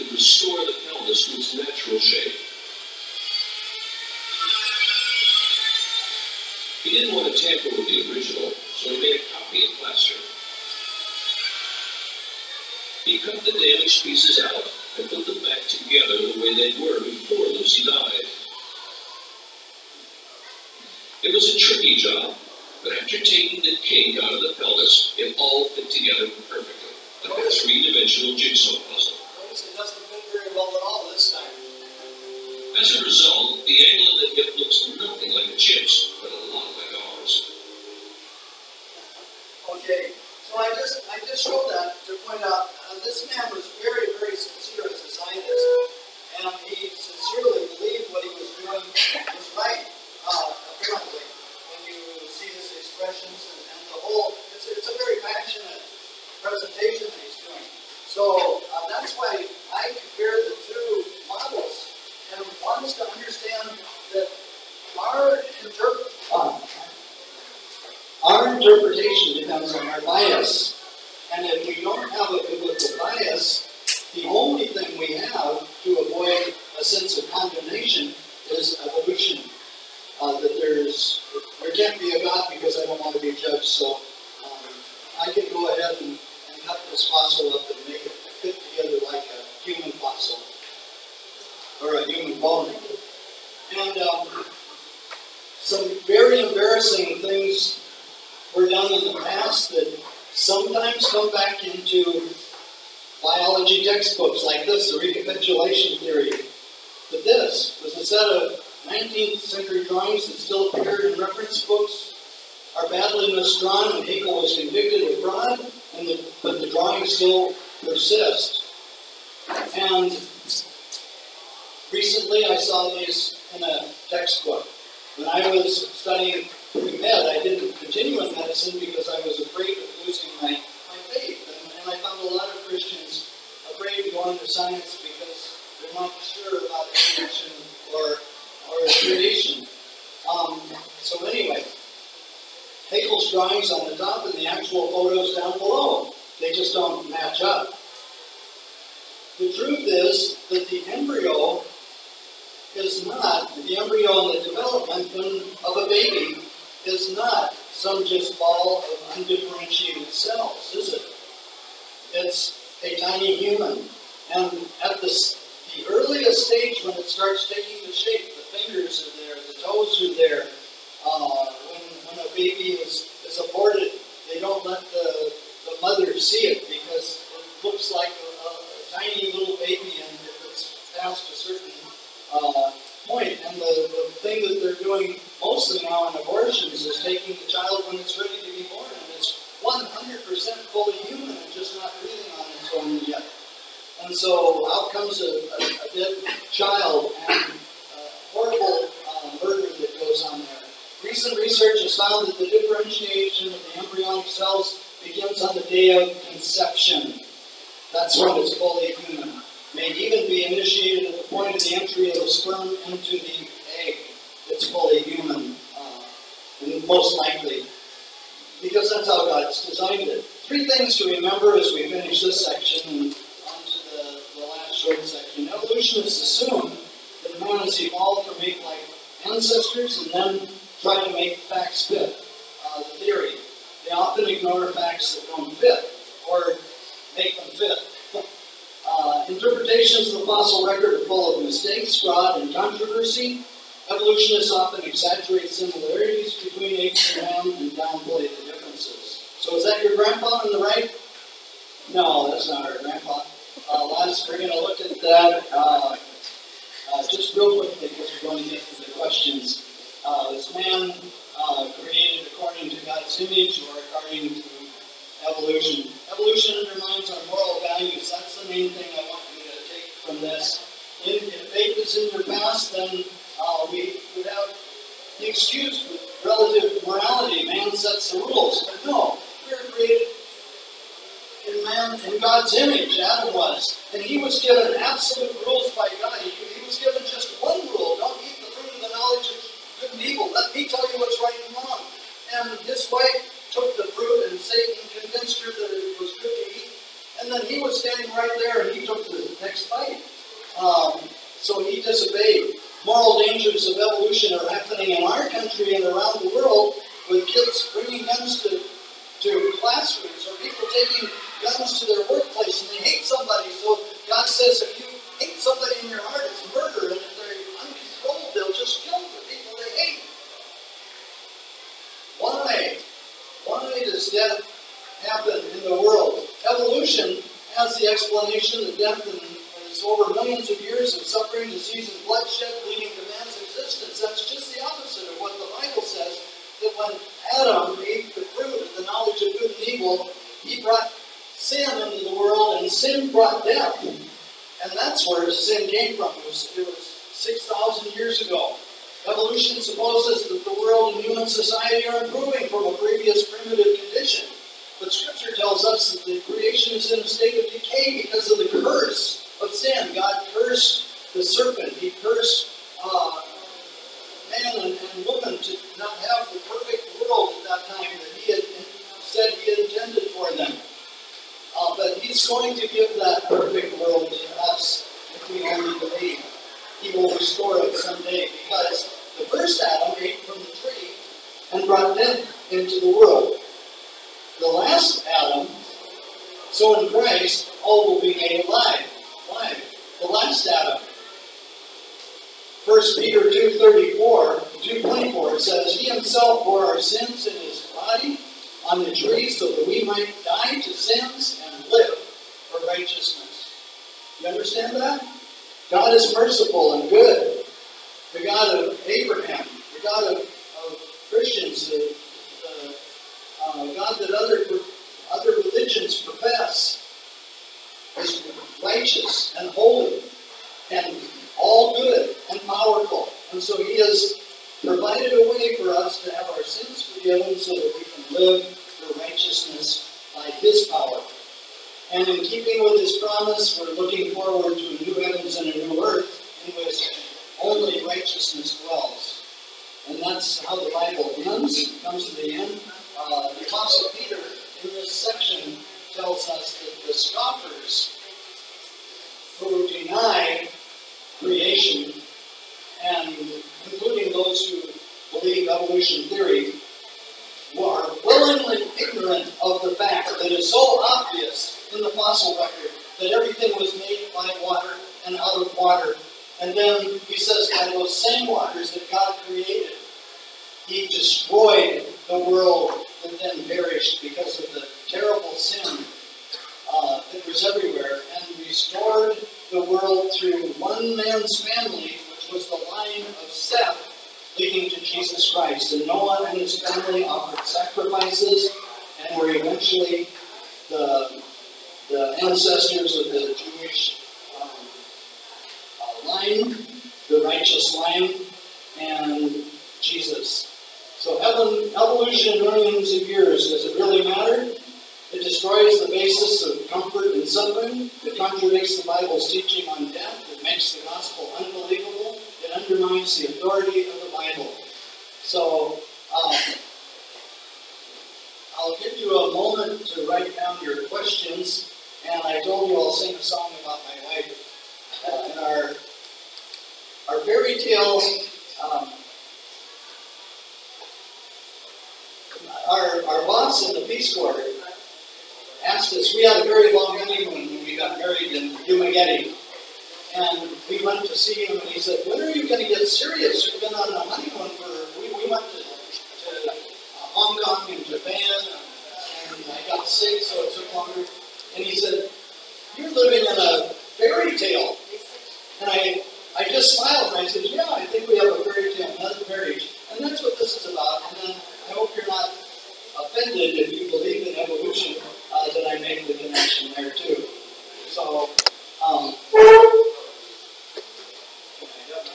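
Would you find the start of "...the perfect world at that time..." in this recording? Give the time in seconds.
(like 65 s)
366 s.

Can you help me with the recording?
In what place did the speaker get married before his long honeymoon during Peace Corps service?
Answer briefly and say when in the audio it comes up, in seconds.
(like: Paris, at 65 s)
Dumaguete, at 538 s.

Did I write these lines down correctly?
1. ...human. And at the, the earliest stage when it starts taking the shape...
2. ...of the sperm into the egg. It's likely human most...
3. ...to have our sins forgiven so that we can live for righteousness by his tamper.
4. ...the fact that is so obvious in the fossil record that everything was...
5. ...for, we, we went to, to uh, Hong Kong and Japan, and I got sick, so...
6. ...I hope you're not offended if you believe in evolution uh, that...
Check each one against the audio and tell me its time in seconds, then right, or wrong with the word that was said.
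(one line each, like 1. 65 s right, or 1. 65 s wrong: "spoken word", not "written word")
1. 163 s right
2. 212 s wrong: "fully", not "likely"
3. 426 s wrong: "power", not "tamper"
4. 459 s right
5. 544 s right
6. 561 s right.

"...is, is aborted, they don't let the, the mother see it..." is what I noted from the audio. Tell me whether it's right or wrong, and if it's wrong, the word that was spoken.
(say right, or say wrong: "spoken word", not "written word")
right.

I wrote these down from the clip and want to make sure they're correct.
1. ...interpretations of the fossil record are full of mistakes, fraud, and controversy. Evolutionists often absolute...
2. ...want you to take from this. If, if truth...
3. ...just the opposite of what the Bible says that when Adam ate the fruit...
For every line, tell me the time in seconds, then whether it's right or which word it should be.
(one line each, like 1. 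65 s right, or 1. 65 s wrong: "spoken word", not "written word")
1. 239 s wrong: "exaggerate", not "absolute"
2. 269 s wrong: "faith", not "truth"
3. 334 s right.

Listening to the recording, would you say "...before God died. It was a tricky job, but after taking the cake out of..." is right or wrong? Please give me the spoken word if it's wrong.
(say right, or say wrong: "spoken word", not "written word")
wrong: "Lucy", not "God".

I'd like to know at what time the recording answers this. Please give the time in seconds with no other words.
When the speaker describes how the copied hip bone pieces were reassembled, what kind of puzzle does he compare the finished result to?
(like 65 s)
27 s.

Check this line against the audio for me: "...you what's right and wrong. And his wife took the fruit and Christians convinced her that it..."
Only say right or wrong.
wrong.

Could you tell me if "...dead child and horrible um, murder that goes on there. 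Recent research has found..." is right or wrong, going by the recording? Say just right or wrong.
right.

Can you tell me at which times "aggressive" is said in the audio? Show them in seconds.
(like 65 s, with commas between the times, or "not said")
not said.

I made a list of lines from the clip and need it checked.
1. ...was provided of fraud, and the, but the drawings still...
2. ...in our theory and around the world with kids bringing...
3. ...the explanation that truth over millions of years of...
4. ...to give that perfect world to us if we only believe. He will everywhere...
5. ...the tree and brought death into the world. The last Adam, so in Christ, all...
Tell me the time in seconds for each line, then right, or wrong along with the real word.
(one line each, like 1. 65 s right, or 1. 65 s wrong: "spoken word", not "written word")
1. 114 s wrong: "convicted", not "provided"
2. 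304 s wrong: "country", not "theory"
3. 327 s wrong: "death", not "truth"
4. 372 s wrong: "restore", not "everywhere"
5. 380 s right.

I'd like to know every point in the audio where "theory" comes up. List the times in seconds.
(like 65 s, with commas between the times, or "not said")
105 s, 232 s, 456 s.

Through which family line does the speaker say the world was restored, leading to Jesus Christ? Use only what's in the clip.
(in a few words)
Seth.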